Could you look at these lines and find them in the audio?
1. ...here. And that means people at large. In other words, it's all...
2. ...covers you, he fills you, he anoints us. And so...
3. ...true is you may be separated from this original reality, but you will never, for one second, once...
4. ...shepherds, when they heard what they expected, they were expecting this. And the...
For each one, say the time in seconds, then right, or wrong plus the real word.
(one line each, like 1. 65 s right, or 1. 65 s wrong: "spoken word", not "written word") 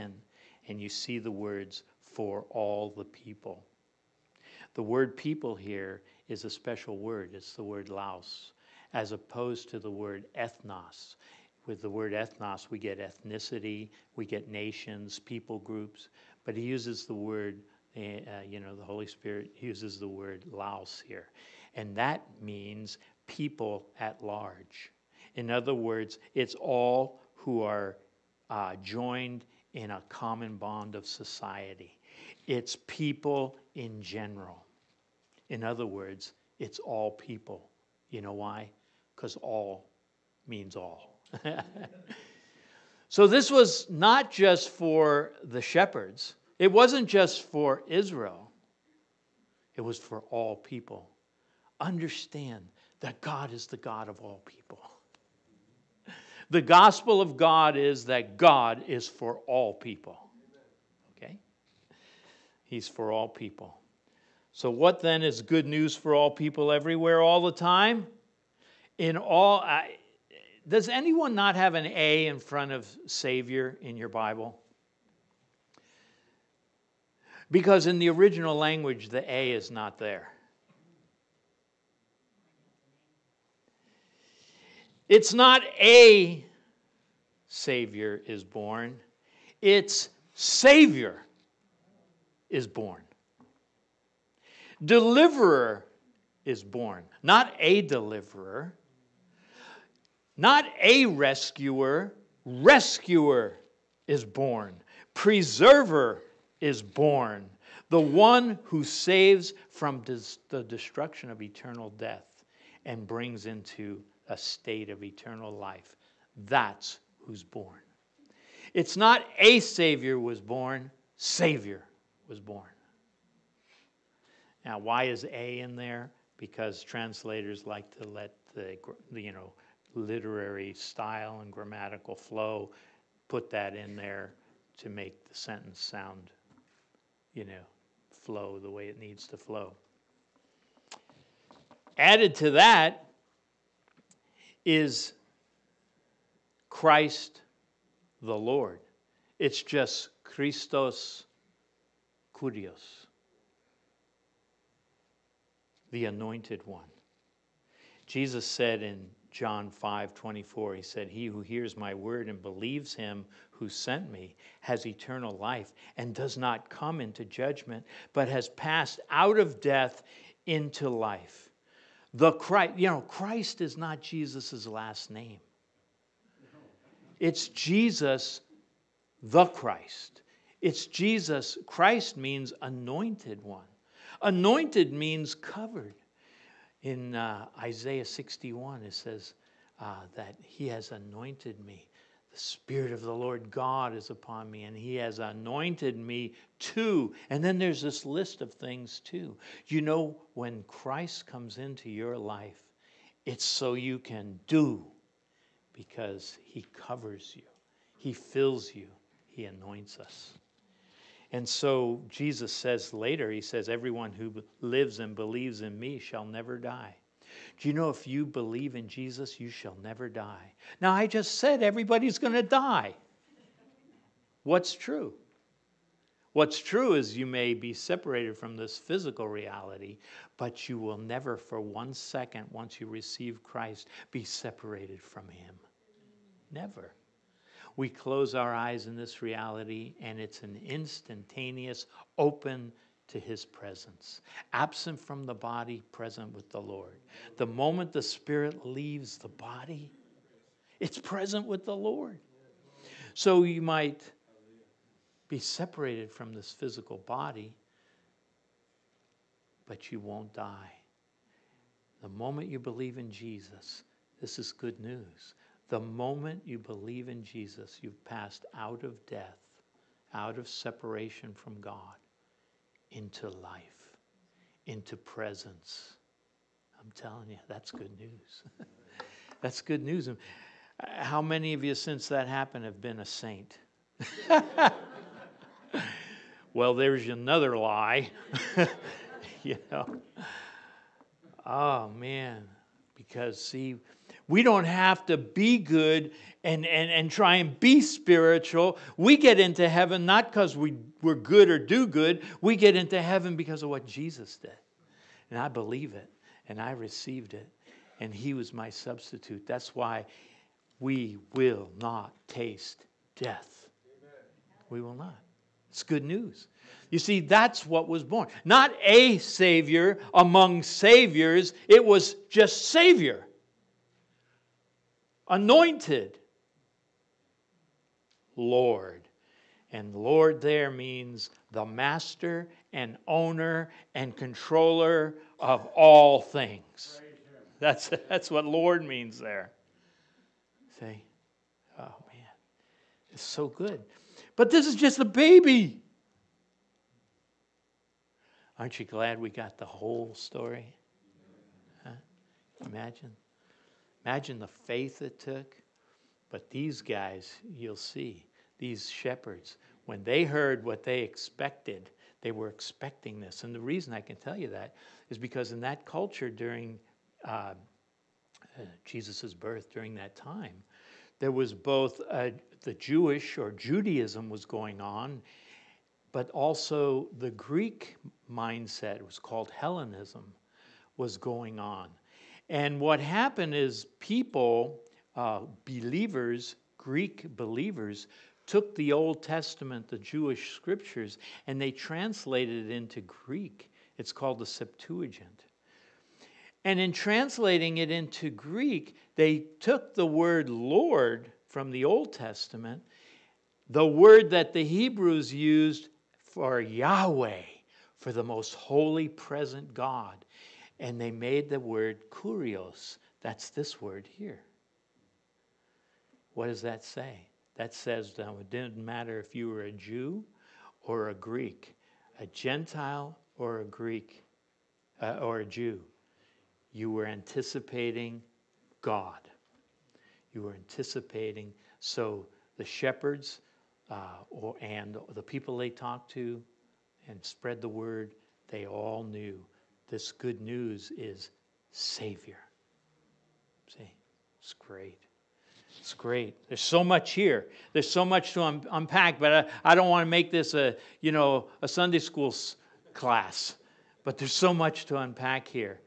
1. 21 s right
2. 206 s right
3. 226 s wrong: "physical", not "original"
4. 358 s right.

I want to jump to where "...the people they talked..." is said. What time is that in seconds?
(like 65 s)
435 s.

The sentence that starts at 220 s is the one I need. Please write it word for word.
Now, I just said everybody's going to die.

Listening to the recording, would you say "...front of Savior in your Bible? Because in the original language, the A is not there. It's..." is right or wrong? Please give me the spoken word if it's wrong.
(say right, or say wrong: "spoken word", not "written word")
right.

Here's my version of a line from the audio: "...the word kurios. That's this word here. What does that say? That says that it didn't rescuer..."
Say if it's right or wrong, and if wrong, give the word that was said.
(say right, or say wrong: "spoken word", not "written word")
wrong: "matter", not "rescuer".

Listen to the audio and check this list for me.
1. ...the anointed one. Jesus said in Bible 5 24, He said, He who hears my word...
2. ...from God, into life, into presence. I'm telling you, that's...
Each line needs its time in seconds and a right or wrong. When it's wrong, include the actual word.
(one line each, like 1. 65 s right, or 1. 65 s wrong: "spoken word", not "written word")
1. 155 s wrong: "John", not "Bible"
2. 271 s right.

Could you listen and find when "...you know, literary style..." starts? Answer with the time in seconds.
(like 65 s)
129 s.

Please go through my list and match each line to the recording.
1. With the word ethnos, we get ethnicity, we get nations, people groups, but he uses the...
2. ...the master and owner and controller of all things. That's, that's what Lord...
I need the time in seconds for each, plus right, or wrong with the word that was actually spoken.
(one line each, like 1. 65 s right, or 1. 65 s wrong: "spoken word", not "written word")
1. 11 s right
2. 331 s right.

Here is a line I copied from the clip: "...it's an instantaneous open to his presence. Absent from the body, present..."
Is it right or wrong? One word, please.
right.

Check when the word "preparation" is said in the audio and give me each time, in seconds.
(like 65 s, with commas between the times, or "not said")
not said.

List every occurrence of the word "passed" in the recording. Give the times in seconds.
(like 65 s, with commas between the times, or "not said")
168 s, 268 s.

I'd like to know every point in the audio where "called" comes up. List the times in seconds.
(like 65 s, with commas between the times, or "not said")
379 s, 394 s.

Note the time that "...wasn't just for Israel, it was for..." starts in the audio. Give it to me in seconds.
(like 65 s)
46 s.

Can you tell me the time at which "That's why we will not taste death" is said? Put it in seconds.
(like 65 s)
309 s.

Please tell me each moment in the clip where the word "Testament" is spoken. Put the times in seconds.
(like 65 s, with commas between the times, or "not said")
389 s, 402 s.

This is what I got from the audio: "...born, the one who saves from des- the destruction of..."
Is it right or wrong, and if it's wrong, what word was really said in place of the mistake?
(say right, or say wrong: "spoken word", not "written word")
right.